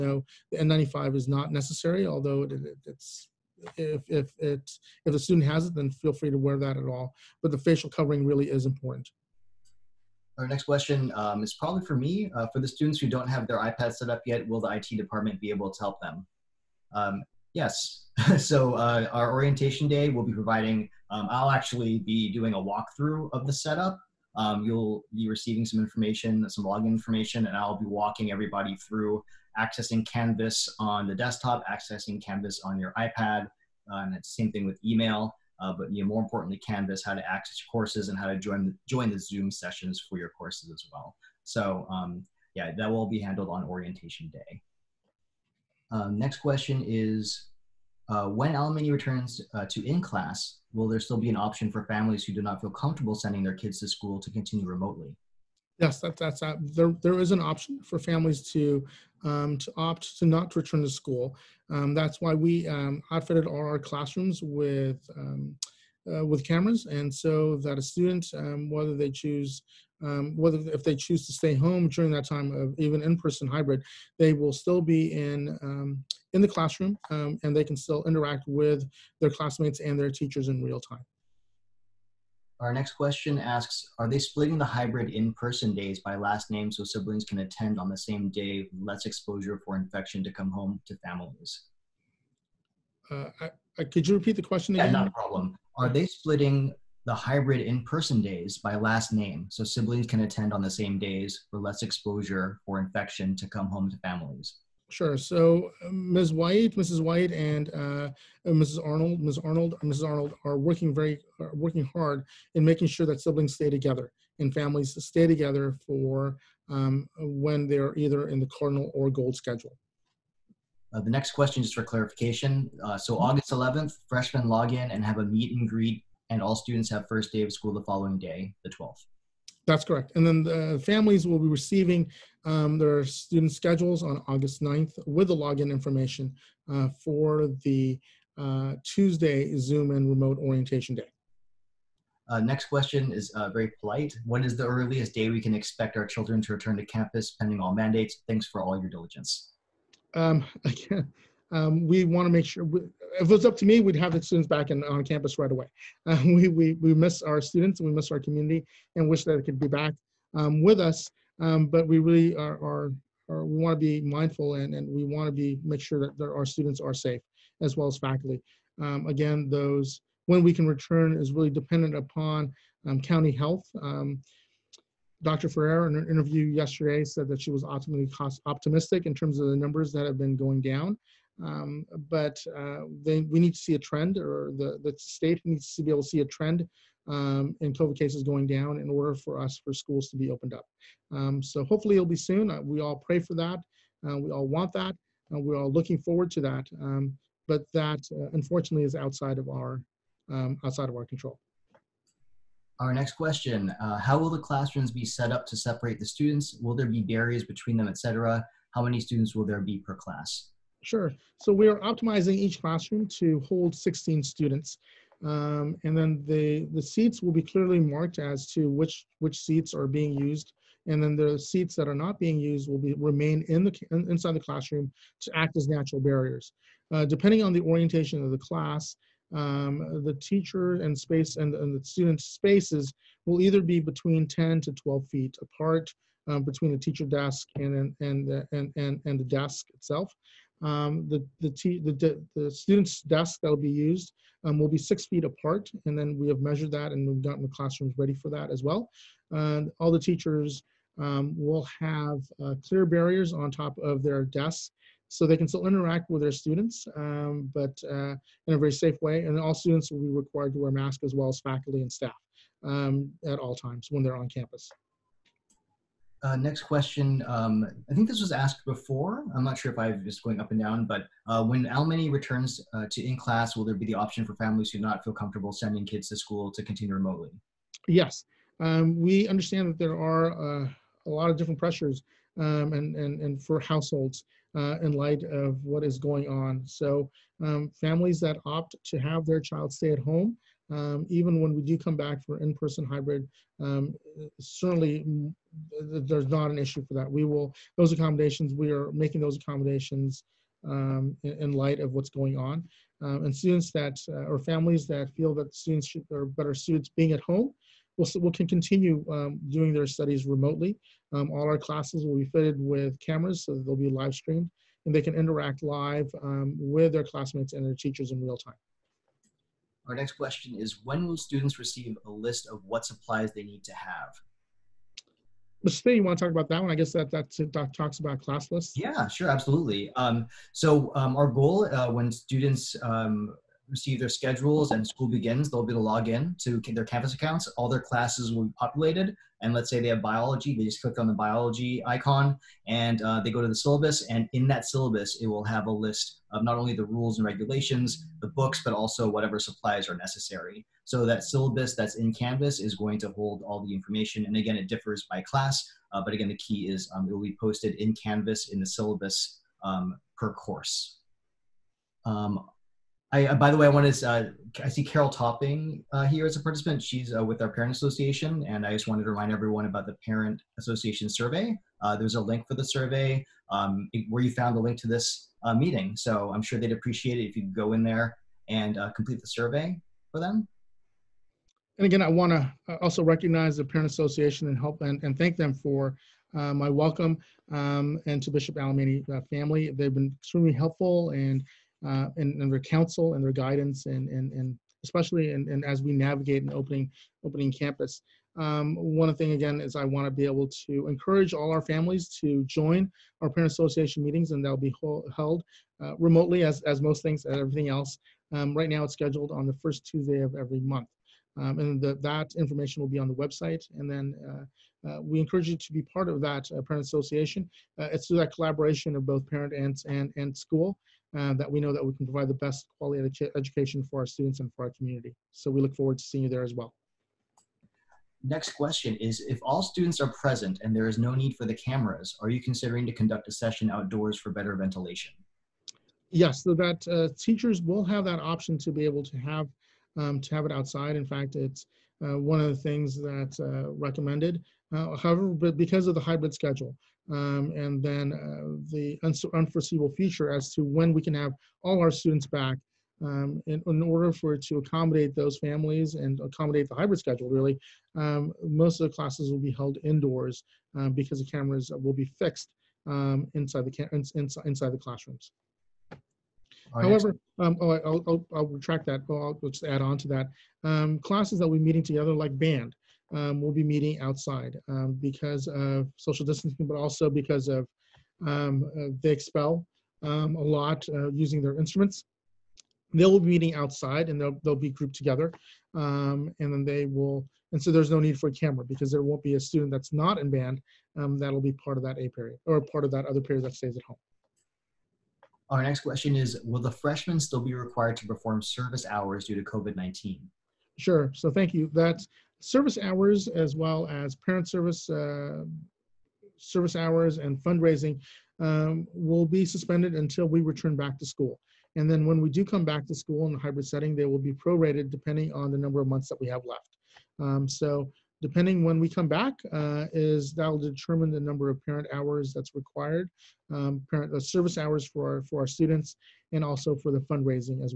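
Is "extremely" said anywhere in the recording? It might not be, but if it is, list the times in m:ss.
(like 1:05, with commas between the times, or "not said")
6:30.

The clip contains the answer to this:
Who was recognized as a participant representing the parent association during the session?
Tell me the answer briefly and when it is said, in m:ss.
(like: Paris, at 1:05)
Carol Topping, at 6:04.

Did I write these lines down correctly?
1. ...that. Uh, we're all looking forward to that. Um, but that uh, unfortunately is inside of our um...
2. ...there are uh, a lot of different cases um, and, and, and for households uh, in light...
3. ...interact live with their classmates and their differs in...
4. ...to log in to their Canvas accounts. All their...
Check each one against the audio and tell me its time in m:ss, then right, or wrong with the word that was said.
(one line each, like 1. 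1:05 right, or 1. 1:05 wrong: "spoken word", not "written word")
1. 3:14 wrong: "outside", not "inside"
2. 4:39 wrong: "pressures", not "cases"
3. 5:15 wrong: "teachers", not "differs"
4. 5:35 right.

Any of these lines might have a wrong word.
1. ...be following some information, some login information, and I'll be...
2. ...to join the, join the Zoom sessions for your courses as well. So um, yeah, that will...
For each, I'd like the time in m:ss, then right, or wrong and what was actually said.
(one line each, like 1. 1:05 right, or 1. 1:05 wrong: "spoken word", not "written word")
1. 0:25 wrong: "receiving", not "following"
2. 0:38 right.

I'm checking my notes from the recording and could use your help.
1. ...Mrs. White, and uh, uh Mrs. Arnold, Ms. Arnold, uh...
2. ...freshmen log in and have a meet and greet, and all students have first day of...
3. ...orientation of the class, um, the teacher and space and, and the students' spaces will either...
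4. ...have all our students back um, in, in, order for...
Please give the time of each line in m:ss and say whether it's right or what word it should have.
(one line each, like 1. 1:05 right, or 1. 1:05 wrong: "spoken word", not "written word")
1. 1:46 right
2. 2:04 right
3. 3:47 right
4. 7:31 right.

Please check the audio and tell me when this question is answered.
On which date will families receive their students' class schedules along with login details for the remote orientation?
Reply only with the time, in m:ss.
2:14.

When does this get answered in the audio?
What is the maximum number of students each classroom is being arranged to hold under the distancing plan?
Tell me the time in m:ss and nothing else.
3:33.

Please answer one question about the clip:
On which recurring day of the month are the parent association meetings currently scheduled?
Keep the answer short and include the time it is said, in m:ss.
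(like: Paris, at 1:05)
first Tuesday, at 6:49.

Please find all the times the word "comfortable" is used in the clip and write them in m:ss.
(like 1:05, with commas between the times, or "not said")
0:52, 4:35.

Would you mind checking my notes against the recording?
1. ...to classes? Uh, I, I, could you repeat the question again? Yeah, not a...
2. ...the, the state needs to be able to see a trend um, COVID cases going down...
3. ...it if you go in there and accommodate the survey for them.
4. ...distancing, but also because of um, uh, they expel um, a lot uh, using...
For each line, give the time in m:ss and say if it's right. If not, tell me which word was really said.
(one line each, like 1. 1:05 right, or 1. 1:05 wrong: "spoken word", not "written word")
1. 1:30 wrong: "families", not "classes"
2. 3:04 right
3. 6:17 wrong: "complete", not "accommodate"
4. 7:56 right.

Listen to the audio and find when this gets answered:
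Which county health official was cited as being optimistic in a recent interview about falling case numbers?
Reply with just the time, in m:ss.
2:55.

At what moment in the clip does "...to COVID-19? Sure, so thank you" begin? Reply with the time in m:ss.
8:19.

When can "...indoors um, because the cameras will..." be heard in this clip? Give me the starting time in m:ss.
7:39.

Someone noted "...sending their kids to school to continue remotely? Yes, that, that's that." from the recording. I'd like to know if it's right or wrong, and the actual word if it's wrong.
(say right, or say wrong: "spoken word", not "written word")
right.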